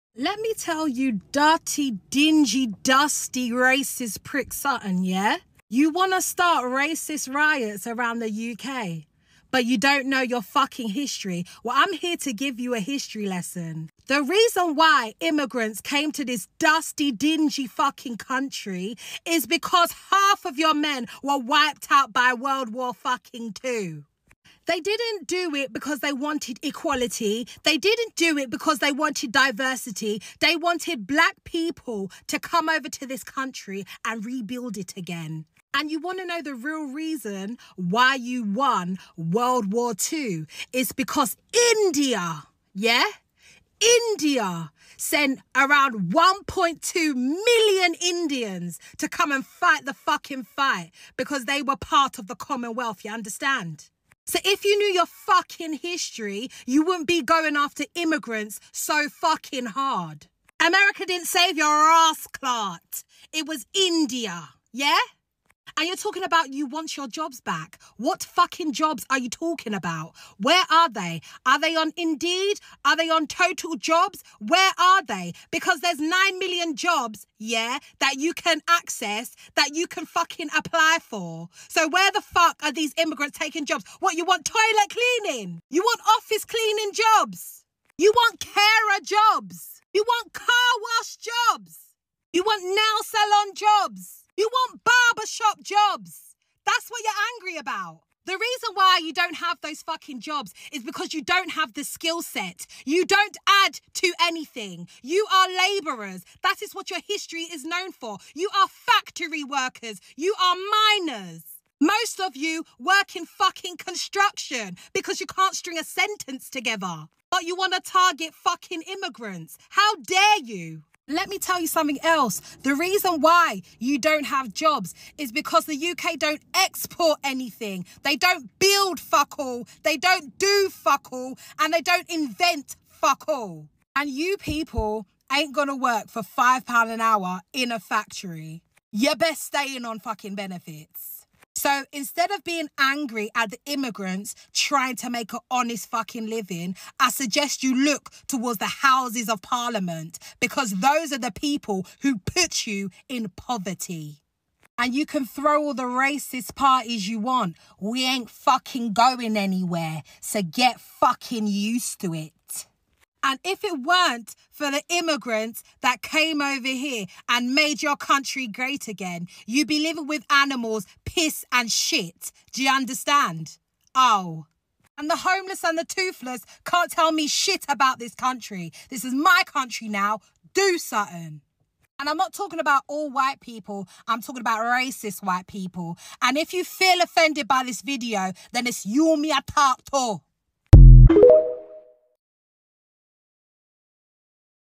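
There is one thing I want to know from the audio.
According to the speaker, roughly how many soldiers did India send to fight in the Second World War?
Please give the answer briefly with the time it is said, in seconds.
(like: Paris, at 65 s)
1.2 million, at 46 s.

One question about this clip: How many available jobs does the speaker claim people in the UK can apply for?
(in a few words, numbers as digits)
9 million.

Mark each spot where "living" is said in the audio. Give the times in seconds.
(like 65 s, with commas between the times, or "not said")
146 s, 169 s.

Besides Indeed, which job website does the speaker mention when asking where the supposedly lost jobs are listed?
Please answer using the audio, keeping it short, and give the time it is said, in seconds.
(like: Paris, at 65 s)
Total Jobs, at 73 s.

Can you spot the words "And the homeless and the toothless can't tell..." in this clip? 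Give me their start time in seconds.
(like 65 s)
174 s.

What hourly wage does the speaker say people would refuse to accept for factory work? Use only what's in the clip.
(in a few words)
£5 an hour.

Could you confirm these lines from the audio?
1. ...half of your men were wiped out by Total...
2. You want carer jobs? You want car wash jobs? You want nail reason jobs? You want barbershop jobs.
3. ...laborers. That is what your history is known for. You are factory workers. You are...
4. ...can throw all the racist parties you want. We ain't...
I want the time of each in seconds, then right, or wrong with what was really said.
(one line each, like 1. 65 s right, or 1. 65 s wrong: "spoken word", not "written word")
1. 20 s wrong: "World", not "Total"
2. 87 s wrong: "salon", not "reason"
3. 105 s right
4. 155 s right.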